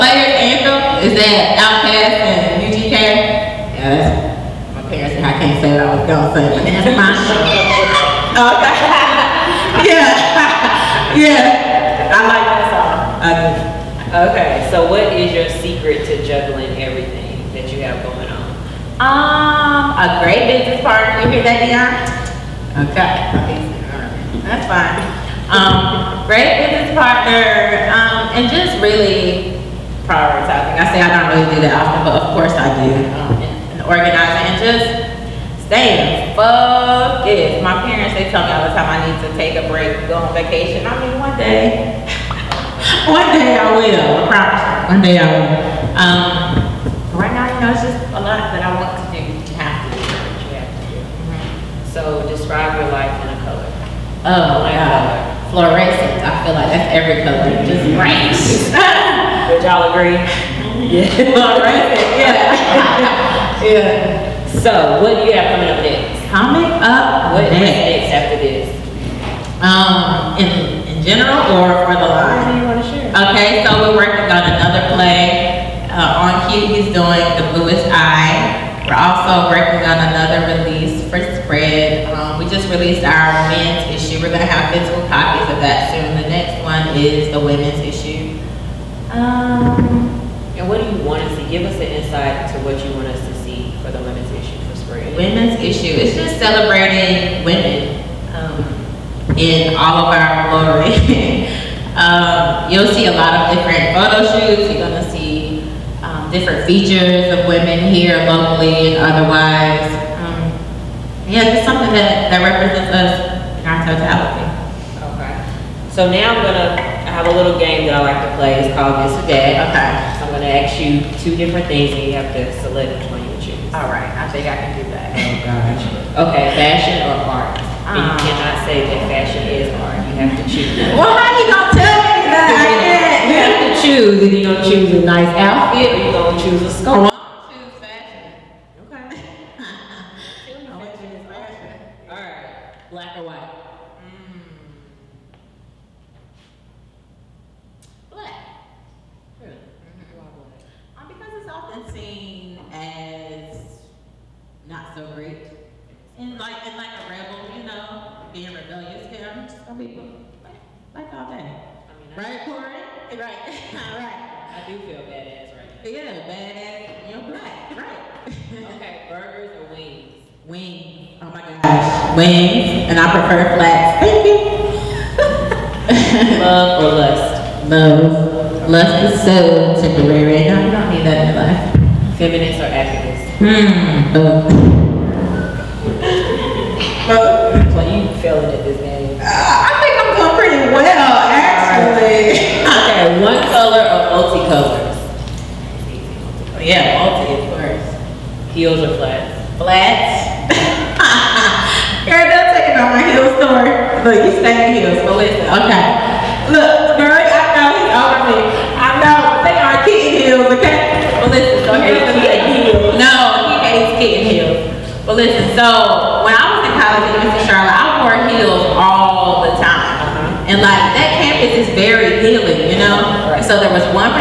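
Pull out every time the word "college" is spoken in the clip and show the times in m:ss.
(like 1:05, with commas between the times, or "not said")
3:36.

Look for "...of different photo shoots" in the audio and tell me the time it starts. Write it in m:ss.
1:43.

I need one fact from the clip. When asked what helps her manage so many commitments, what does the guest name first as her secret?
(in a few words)
A great business partner.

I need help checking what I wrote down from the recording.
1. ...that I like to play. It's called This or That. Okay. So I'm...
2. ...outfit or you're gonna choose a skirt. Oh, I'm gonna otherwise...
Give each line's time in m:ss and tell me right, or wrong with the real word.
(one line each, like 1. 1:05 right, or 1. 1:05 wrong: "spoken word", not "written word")
1. 1:57 right
2. 2:15 wrong: "choose", not "otherwise".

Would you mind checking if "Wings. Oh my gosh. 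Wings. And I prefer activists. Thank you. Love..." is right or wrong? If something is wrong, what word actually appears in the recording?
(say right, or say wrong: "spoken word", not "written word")
wrong: "flats", not "activists".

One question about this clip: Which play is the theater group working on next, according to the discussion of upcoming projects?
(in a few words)
The Bluest Eye.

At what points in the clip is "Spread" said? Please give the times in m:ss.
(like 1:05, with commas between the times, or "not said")
1:21, 1:34.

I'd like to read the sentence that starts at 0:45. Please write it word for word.
Um, right now, you know, it's just a lot that I want so describe your life in a color.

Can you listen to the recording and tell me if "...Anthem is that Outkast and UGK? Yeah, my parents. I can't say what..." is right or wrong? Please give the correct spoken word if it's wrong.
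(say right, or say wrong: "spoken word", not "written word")
right.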